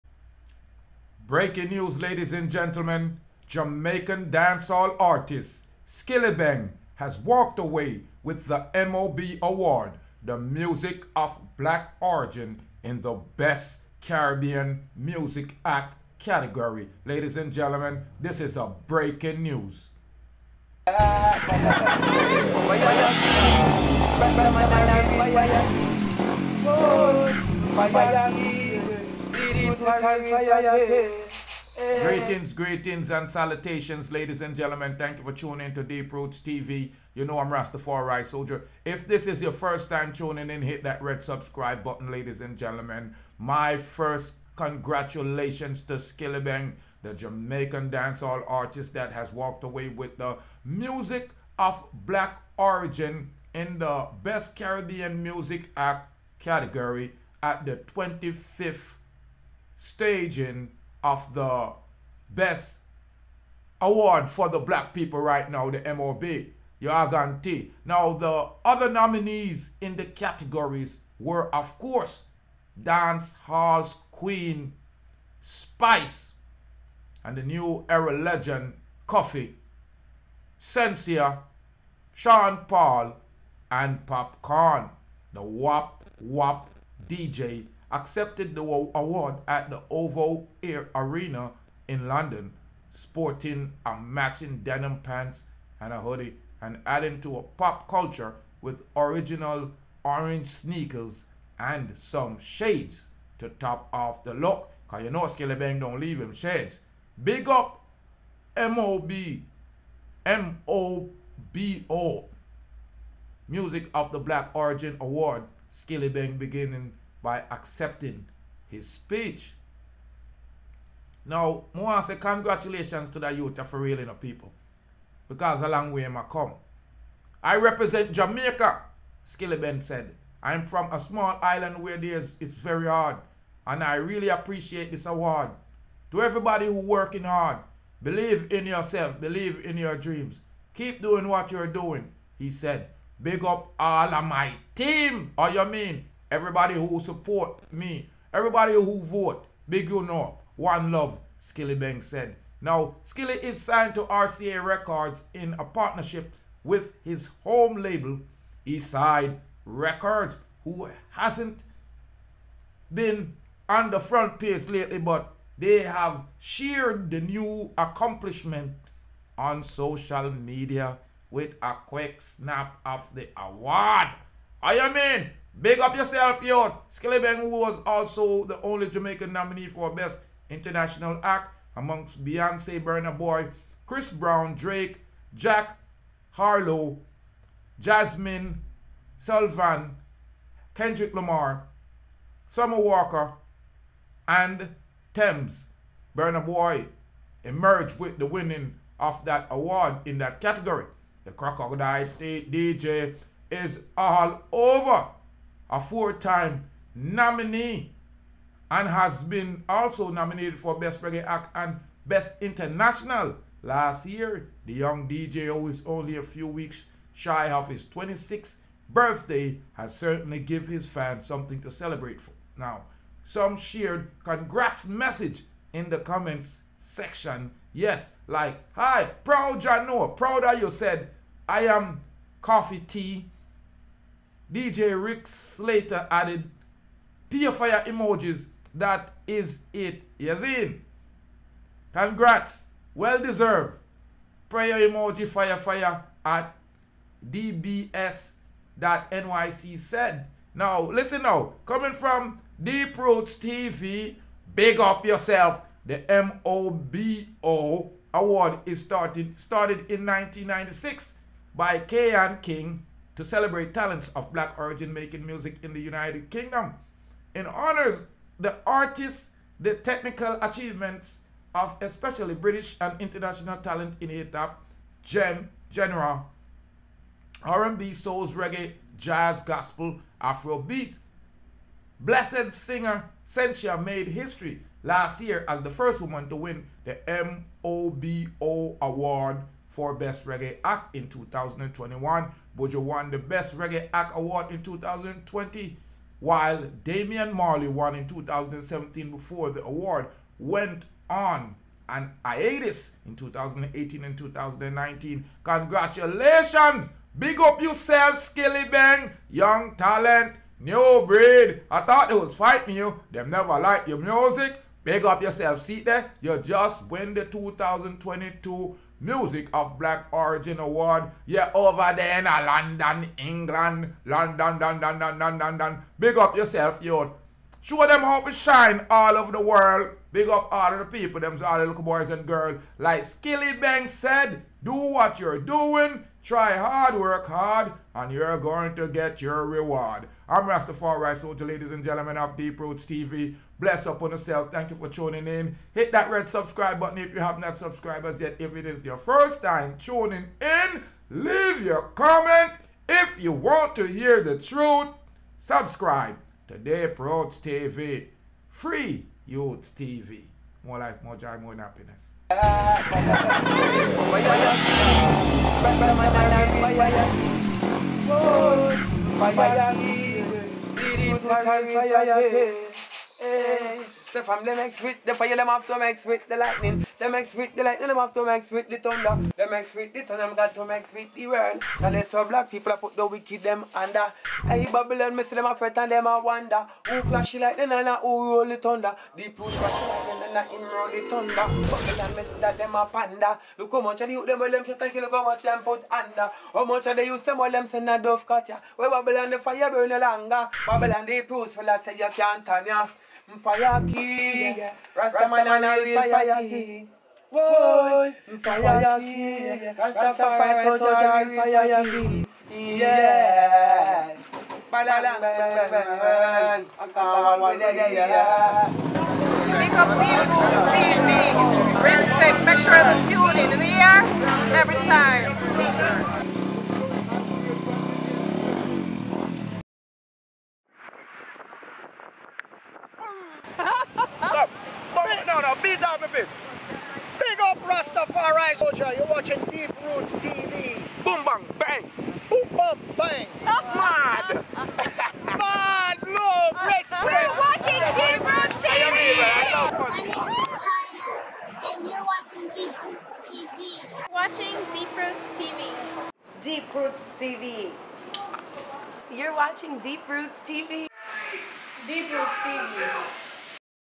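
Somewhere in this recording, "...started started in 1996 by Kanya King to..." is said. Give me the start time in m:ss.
4:18.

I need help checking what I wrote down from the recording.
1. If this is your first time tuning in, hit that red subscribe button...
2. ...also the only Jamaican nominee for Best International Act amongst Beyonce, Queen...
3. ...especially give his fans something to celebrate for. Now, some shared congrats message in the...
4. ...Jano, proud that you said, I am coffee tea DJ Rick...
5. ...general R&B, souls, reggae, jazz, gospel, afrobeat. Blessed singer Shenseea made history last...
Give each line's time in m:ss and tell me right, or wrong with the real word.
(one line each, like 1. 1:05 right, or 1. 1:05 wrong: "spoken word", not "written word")
1. 0:38 right
2. 2:57 wrong: "Burna", not "Queen"
3. 3:39 wrong: "certainly", not "especially"
4. 3:49 right
5. 4:35 right.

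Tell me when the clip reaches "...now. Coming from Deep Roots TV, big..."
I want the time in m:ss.
4:11.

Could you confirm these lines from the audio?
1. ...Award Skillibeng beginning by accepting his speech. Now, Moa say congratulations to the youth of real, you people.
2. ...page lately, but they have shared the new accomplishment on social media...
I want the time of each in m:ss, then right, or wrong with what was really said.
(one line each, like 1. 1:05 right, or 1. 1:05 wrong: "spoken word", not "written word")
1. 1:54 right
2. 2:44 right.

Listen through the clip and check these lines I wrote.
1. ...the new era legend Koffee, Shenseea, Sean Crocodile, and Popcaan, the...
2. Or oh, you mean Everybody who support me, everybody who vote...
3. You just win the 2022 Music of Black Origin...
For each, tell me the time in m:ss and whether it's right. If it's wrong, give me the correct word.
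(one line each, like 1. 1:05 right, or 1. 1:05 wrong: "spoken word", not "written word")
1. 1:17 wrong: "Paul", not "Crocodile"
2. 2:25 right
3. 5:16 right.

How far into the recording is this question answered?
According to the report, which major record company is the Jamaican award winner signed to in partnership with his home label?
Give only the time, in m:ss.
2:34.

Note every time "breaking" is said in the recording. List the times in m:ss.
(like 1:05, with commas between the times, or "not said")
0:01, 0:18.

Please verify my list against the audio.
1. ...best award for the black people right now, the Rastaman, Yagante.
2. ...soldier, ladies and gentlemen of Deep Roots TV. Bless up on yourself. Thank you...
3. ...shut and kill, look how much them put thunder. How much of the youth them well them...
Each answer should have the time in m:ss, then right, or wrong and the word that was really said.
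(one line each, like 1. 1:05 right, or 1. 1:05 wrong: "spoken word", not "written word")
1. 1:02 wrong: "MOB", not "Rastaman"
2. 5:41 right
3. 6:34 wrong: "under", not "thunder".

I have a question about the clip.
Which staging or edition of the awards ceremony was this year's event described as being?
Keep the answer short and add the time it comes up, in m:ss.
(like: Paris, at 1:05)
25th, at 0:57.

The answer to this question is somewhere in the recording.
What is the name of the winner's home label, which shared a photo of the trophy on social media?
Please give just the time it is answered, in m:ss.
2:38.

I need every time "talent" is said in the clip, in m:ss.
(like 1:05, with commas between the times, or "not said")
4:23, 4:33, 5:09.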